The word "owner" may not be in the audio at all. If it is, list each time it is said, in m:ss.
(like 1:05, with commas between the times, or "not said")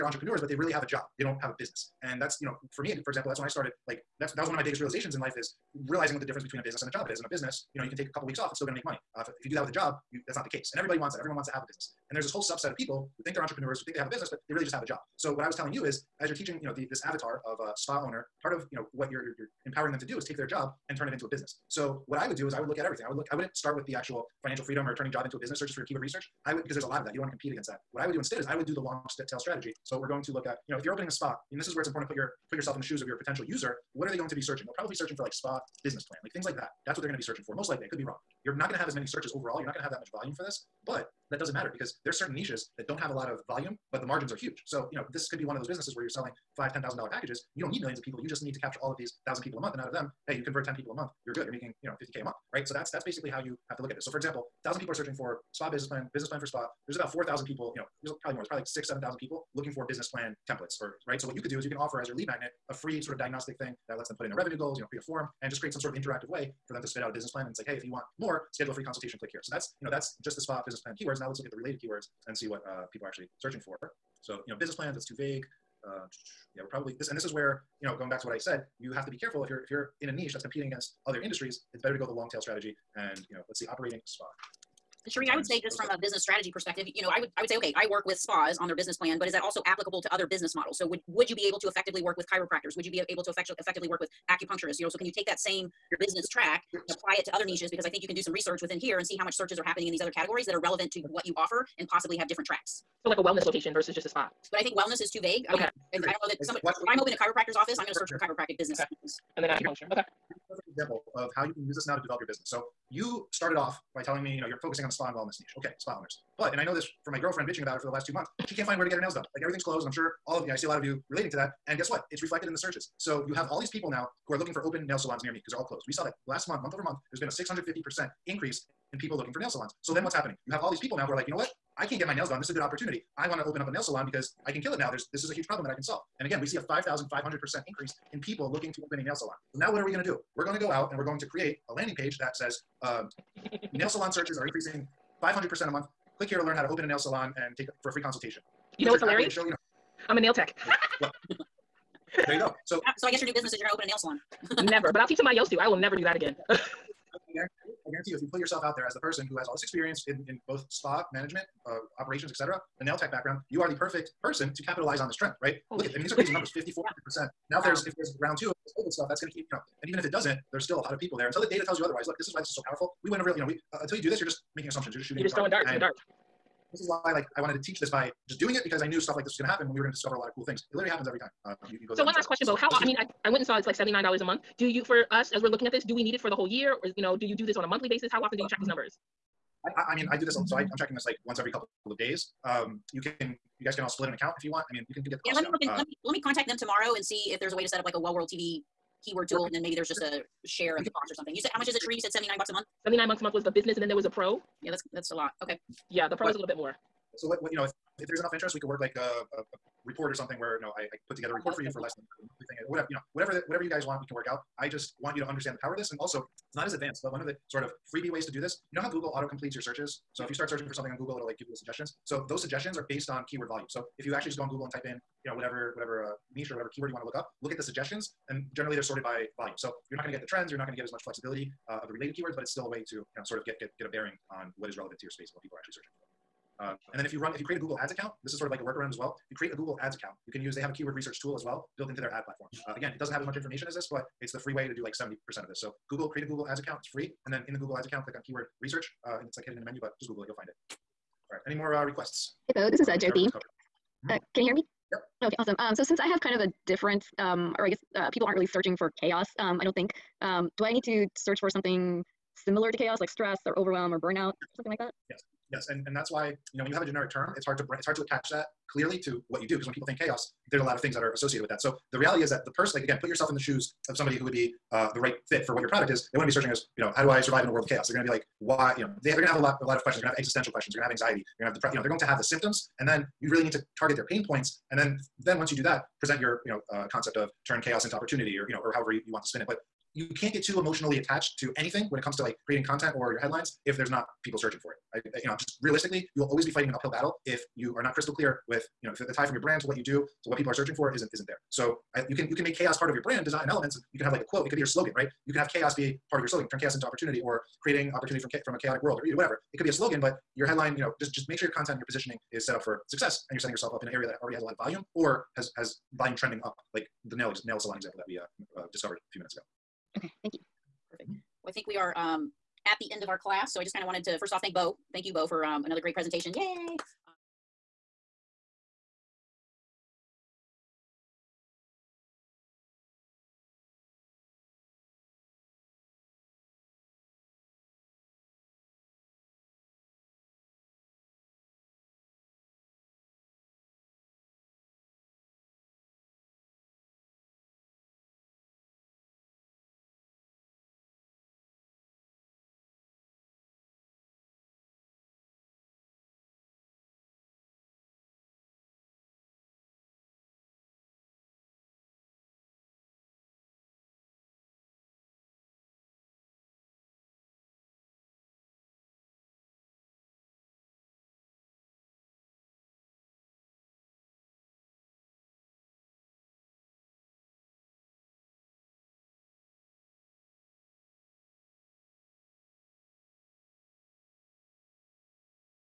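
0:18, 1:56.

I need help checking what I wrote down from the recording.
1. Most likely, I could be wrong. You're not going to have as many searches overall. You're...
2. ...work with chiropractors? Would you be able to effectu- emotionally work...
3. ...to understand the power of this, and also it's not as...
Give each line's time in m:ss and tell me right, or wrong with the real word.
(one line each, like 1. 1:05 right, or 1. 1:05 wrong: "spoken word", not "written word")
1. 0:37 right
2. 1:32 wrong: "effectively", not "emotionally"
3. 3:35 right.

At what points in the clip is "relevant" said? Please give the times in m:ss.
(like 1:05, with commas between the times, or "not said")
1:40, 3:54.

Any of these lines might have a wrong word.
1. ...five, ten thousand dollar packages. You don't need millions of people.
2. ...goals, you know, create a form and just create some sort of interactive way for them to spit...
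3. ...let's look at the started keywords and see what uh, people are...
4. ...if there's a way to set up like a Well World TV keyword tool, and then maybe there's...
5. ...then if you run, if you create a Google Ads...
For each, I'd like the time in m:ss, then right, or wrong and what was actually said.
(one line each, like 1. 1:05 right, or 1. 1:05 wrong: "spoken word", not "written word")
1. 0:46 right
2. 1:04 right
3. 1:11 wrong: "related", not "started"
4. 3:17 right
5. 3:56 right.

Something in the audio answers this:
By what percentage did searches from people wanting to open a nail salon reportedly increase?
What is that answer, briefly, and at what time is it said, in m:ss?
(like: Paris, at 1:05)
5,500%, at 2:16.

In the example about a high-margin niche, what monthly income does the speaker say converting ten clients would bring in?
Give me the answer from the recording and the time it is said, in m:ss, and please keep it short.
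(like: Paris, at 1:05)
50k, at 0:52.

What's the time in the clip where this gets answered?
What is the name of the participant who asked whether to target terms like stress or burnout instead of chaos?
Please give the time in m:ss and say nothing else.
4:13.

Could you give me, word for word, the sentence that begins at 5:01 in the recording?
So I, you can you can make chaos part of your brand design and elements, and you can have like a quote.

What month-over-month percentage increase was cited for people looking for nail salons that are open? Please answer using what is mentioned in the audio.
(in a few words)
650%.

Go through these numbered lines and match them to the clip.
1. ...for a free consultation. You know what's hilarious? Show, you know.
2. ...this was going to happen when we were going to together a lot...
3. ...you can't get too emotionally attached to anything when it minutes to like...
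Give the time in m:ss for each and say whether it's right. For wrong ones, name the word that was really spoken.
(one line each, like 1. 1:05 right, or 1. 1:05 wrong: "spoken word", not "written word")
1. 2:27 right
2. 2:59 wrong: "discover", not "together"
3. 4:49 wrong: "comes", not "minutes".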